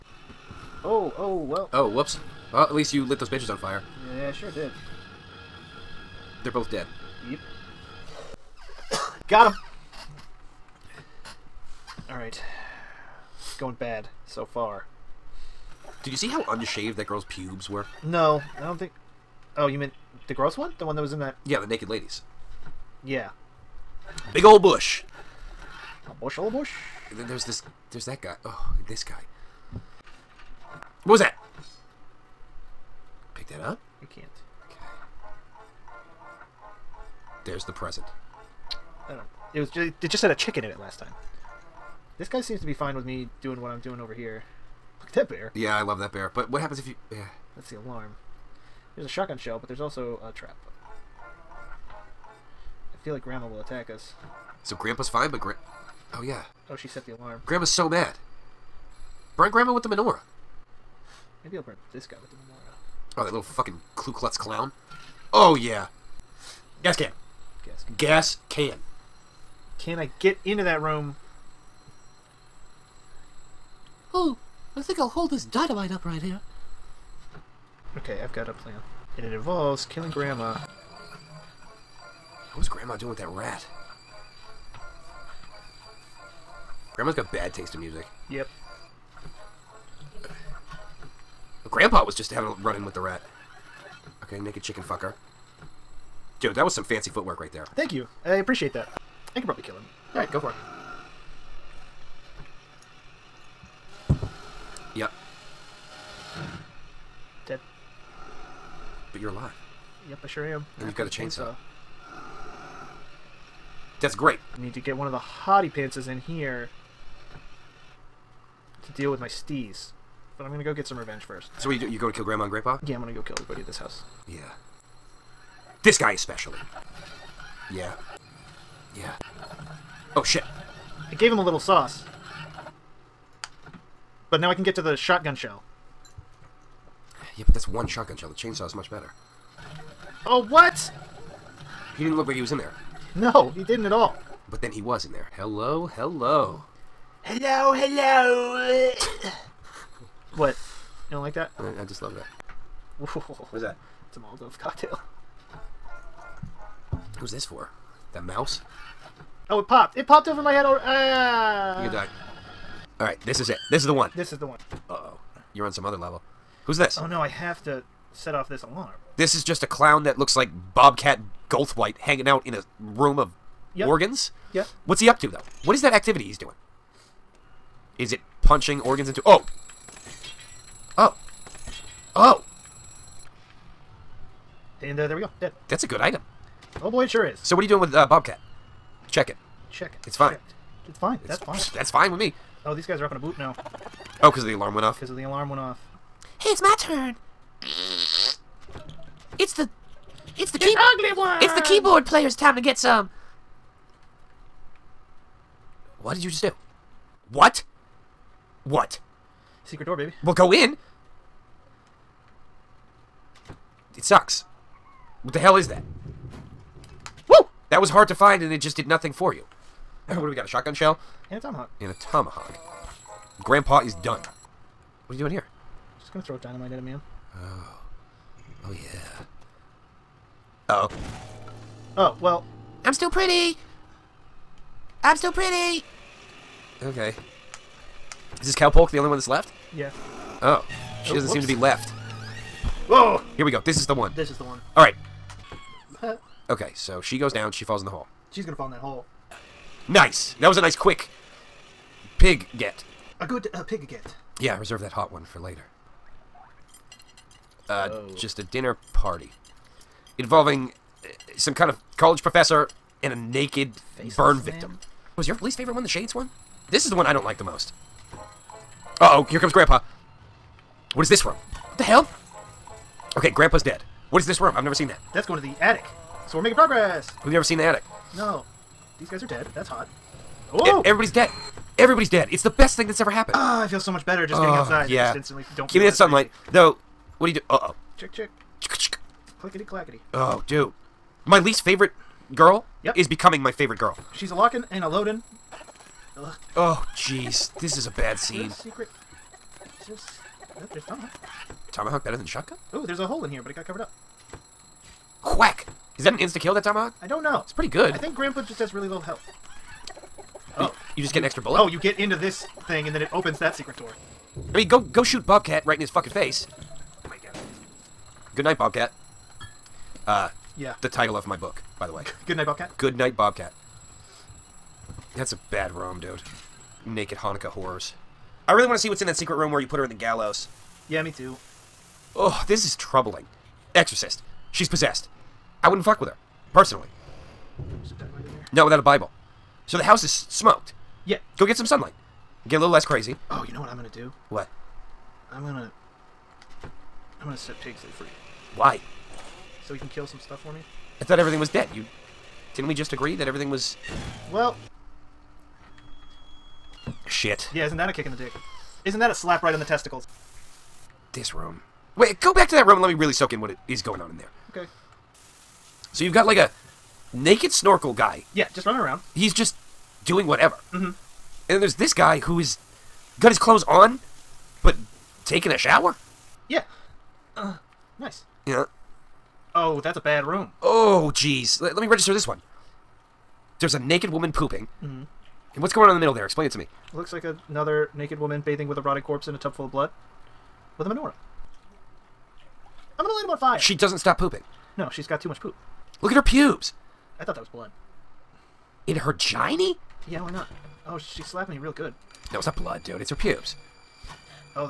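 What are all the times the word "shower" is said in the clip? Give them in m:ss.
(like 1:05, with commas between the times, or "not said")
6:15.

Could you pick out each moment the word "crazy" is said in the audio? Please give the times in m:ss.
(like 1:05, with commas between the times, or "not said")
4:46, 5:42.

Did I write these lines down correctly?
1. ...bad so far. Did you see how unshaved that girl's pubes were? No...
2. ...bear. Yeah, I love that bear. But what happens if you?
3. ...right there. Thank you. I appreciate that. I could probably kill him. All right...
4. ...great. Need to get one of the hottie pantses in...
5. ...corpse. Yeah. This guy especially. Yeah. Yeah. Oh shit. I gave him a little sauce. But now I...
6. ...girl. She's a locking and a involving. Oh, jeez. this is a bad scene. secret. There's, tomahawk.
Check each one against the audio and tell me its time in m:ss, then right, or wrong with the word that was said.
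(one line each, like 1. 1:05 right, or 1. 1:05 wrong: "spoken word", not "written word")
1. 0:13 right
2. 0:45 right
3. 1:37 right
4. 1:54 right
5. 2:03 wrong: "house", not "corpse"
6. 4:53 wrong: "loading", not "involving".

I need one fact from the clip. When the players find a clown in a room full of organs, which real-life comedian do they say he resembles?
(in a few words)
Bobcat Goldthwait.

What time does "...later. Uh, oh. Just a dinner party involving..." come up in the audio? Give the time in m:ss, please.
4:15.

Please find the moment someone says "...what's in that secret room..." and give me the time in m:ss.
5:28.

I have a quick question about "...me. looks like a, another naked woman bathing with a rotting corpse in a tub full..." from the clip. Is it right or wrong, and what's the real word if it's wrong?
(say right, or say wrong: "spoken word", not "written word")
right.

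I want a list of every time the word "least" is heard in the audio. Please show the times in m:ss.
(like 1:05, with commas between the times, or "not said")
0:02, 4:25, 4:51.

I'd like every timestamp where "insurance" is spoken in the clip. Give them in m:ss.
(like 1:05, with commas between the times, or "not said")
not said.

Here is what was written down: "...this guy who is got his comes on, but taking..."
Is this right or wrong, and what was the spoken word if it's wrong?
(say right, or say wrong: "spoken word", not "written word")
wrong: "clothes", not "comes".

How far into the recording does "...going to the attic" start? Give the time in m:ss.
4:35.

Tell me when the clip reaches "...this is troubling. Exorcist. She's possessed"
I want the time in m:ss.
5:32.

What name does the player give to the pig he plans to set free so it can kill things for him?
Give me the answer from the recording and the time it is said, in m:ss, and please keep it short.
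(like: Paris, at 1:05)
Pigsley, at 5:47.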